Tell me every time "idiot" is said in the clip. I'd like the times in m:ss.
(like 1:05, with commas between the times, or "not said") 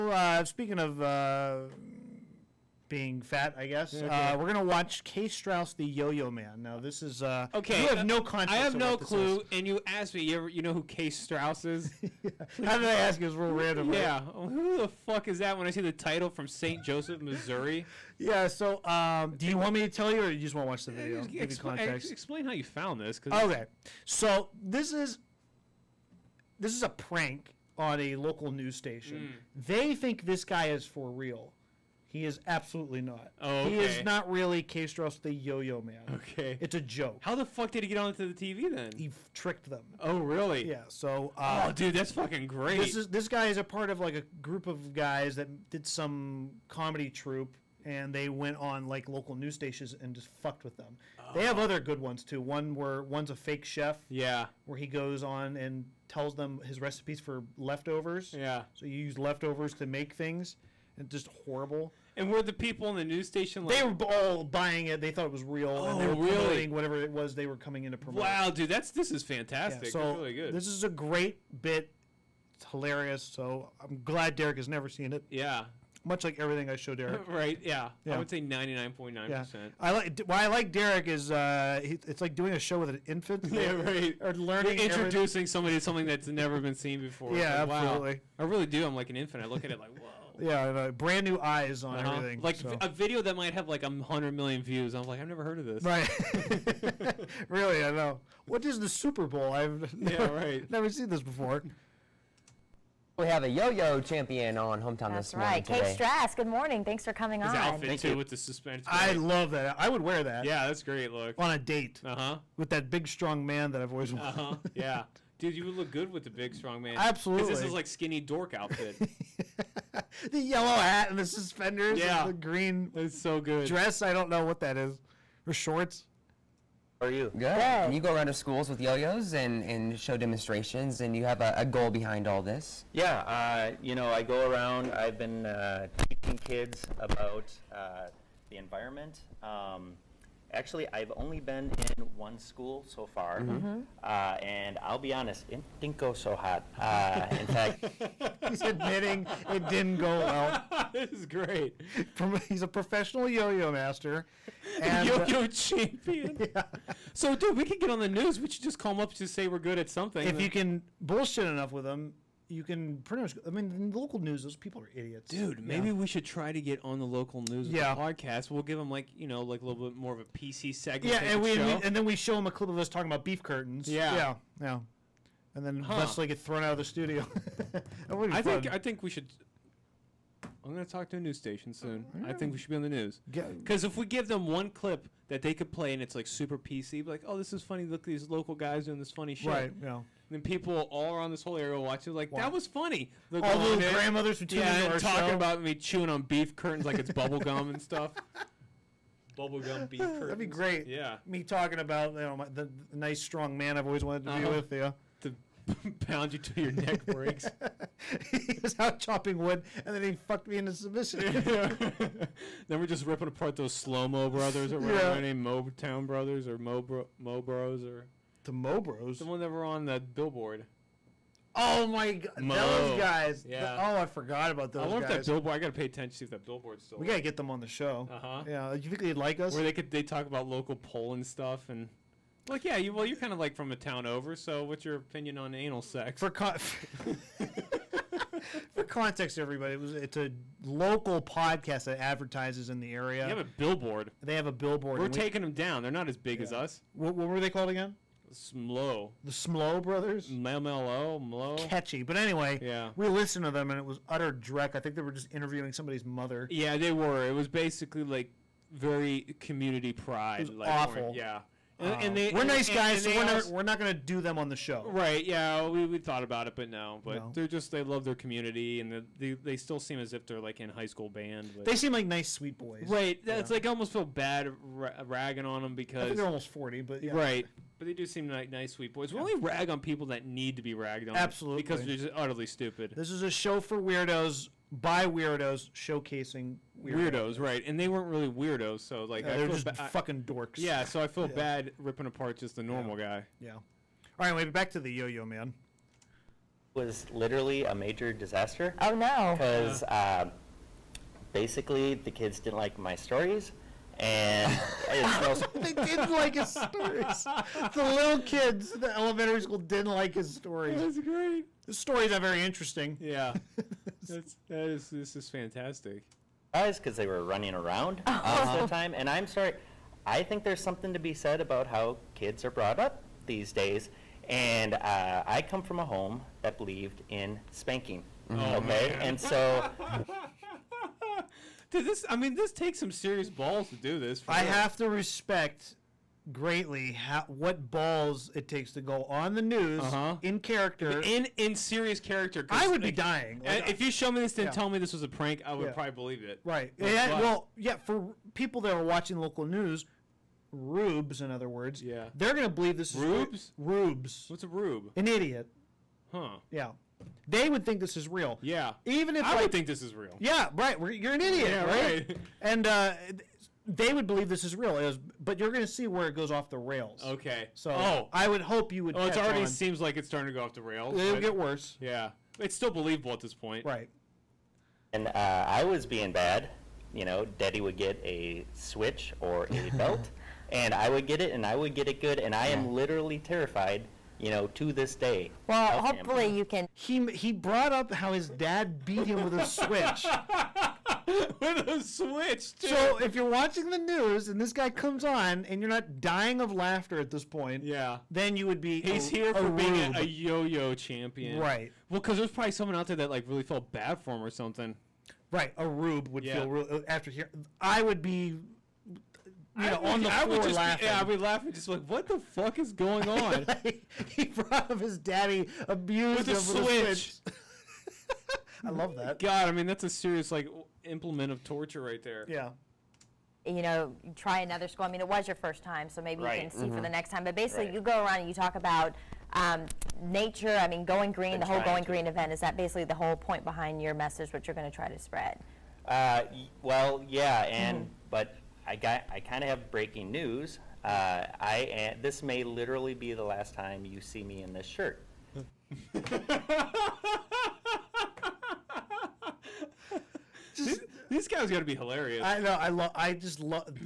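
2:44, 5:55, 6:01.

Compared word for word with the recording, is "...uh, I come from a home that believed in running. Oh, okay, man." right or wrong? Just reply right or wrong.
wrong.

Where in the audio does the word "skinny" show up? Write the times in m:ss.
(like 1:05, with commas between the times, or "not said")
1:57.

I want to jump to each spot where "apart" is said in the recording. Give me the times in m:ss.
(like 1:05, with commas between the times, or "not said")
3:33, 4:52.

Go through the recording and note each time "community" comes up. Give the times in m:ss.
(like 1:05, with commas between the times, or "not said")
4:19, 4:28.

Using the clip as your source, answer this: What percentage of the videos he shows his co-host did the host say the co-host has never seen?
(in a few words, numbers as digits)
99.9%.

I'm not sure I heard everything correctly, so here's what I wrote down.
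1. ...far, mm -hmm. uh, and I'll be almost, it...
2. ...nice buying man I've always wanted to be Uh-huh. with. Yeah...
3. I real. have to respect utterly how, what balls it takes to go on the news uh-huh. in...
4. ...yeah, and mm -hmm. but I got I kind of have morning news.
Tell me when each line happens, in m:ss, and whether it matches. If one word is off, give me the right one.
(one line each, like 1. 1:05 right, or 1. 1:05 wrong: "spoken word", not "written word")
1. 2:23 wrong: "honest", not "almost"
2. 3:22 wrong: "strong", not "buying"
3. 5:34 wrong: "greatly", not "utterly"
4. 7:17 wrong: "breaking", not "morning".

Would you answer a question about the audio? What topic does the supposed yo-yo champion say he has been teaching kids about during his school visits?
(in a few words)
The environment.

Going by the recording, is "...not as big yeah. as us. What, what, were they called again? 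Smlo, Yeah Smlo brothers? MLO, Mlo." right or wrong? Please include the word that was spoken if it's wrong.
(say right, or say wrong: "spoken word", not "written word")
wrong: "The", not "Yeah".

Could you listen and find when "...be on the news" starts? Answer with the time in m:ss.
3:02.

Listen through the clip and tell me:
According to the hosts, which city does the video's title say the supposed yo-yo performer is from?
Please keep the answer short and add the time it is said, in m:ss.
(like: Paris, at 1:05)
St. Joseph, Missouri, at 0:16.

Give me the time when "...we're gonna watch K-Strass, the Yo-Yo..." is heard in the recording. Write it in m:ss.
0:04.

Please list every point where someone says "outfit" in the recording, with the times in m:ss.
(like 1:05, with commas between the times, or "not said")
1:47, 1:58.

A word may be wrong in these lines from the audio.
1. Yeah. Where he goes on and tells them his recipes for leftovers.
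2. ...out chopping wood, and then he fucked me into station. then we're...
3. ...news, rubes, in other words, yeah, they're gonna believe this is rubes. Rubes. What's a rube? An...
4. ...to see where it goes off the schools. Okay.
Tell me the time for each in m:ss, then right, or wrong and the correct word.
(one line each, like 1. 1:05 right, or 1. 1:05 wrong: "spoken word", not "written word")
1. 0:54 right
2. 3:28 wrong: "submission", not "station"
3. 5:49 right
4. 6:05 wrong: "rails", not "schools".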